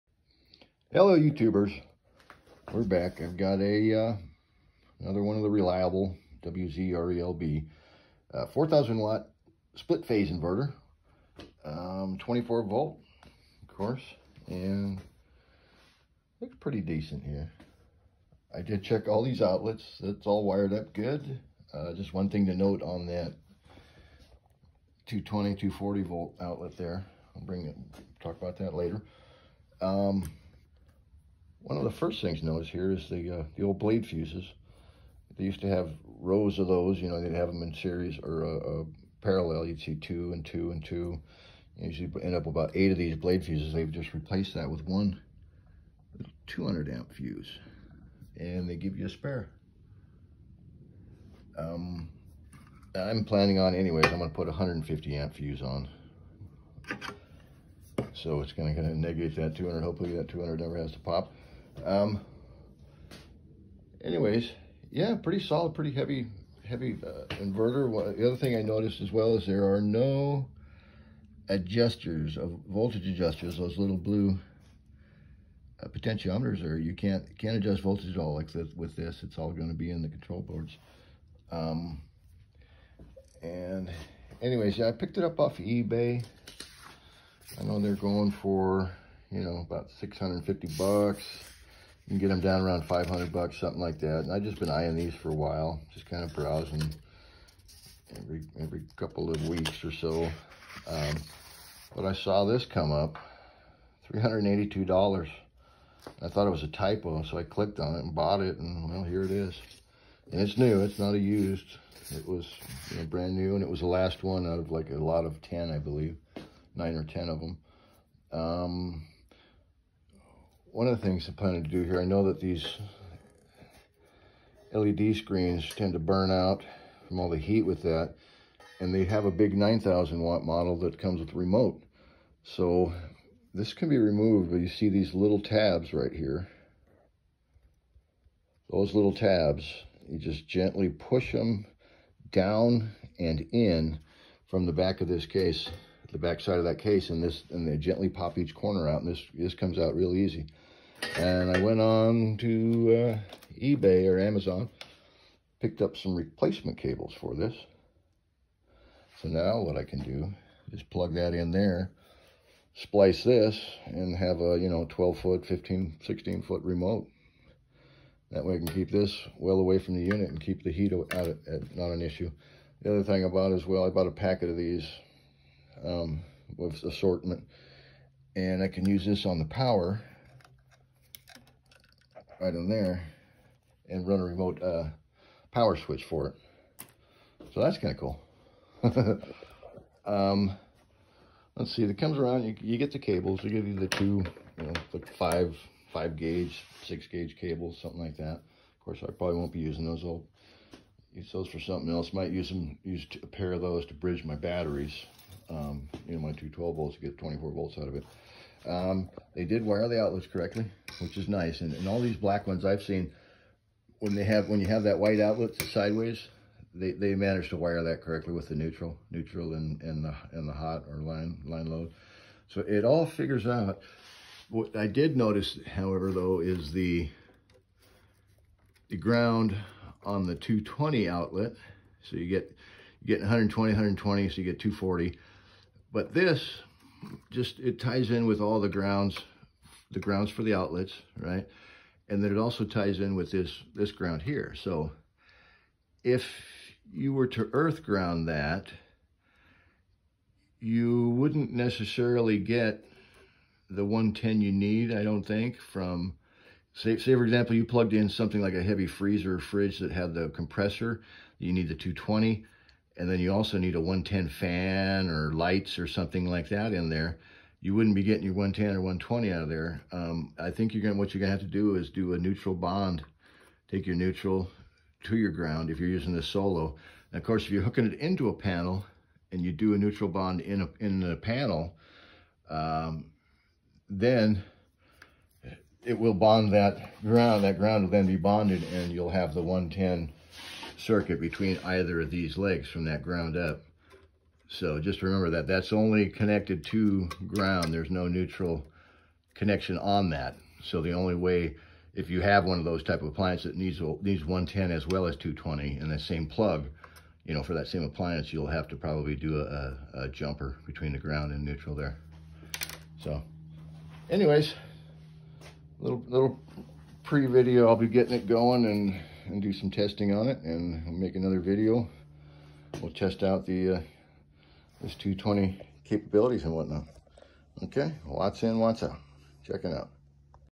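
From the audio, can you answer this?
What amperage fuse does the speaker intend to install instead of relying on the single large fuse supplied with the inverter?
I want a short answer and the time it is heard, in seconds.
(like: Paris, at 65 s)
150 amp, at 54 s.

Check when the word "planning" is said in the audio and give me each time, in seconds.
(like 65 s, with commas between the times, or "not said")
53 s, 121 s.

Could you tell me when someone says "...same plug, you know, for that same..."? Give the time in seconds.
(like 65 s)
305 s.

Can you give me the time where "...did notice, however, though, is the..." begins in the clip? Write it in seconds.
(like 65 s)
224 s.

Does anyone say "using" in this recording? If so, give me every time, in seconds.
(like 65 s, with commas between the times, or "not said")
199 s, 275 s.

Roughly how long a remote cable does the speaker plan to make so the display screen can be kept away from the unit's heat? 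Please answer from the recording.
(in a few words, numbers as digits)
15-16 feet.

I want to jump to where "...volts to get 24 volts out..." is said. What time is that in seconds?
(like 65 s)
206 s.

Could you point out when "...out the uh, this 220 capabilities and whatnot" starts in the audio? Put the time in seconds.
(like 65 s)
323 s.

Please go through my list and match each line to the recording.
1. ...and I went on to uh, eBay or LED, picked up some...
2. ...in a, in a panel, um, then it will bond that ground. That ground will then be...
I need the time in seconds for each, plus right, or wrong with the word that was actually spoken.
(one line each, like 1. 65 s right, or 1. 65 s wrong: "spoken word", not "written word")
1. 151 s wrong: "Amazon", not "LED"
2. 280 s right.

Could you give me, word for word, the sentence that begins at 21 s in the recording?
Uh, just one thing to note on that 220, 240 volt outlet there.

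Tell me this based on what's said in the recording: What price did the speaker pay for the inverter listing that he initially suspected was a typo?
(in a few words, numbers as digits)
$382.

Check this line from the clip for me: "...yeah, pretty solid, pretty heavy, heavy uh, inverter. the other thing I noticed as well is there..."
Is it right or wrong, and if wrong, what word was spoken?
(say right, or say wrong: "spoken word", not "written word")
right.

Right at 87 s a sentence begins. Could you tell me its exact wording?
I know they're going for, you know, about 650 bucks can get them down around 500 bucks, something like that.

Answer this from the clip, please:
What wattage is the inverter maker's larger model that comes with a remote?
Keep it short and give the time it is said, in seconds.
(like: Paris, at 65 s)
9,000 watt, at 129 s.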